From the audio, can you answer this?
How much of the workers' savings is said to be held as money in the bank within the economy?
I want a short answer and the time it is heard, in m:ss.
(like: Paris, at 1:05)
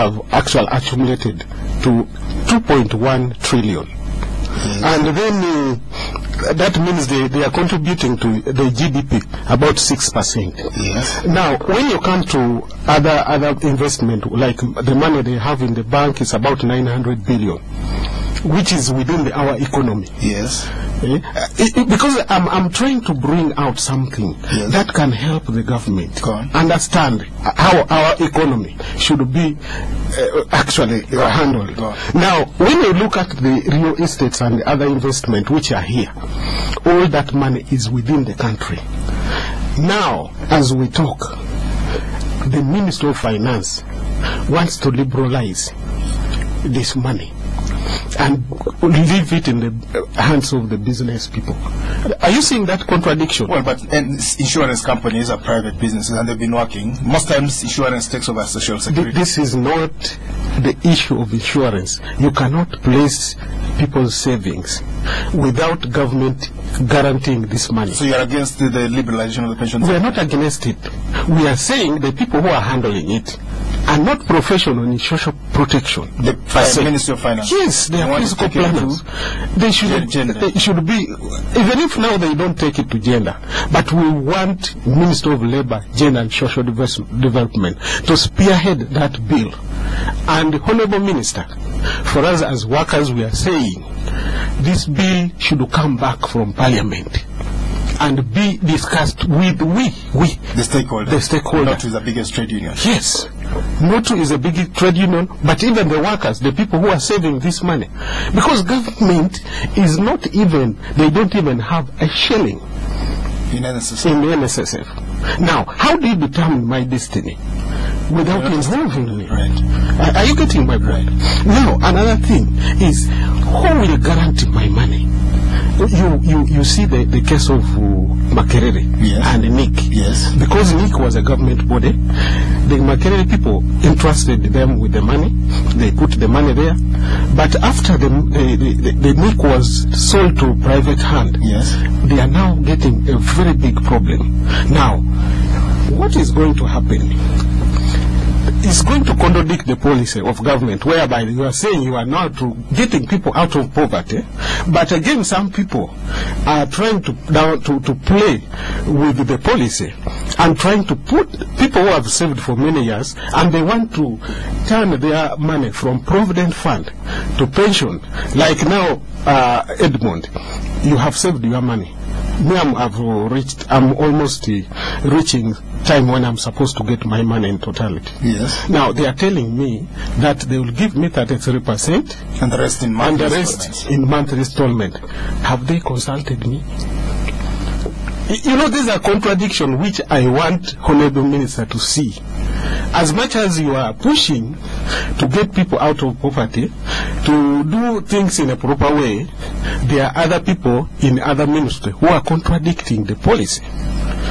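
900 billion, at 0:16.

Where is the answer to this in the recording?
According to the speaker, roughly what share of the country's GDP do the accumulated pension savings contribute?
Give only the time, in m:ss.
0:09.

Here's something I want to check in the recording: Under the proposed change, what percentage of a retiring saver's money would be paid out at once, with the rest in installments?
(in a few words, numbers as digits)
33 percent.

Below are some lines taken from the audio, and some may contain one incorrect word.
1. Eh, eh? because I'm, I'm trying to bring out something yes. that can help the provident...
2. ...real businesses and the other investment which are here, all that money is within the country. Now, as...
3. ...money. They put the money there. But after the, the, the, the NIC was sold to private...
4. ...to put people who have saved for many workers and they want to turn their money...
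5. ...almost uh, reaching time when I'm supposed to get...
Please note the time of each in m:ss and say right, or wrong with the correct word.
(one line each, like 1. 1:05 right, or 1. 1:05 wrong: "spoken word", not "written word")
1. 0:21 wrong: "government", not "provident"
2. 0:33 wrong: "estates", not "businesses"
3. 2:15 right
4. 2:40 wrong: "years", not "workers"
5. 2:53 right.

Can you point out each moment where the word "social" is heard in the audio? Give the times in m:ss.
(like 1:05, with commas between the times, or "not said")
0:58, 1:14, 1:26.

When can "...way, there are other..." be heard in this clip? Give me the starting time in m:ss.
3:18.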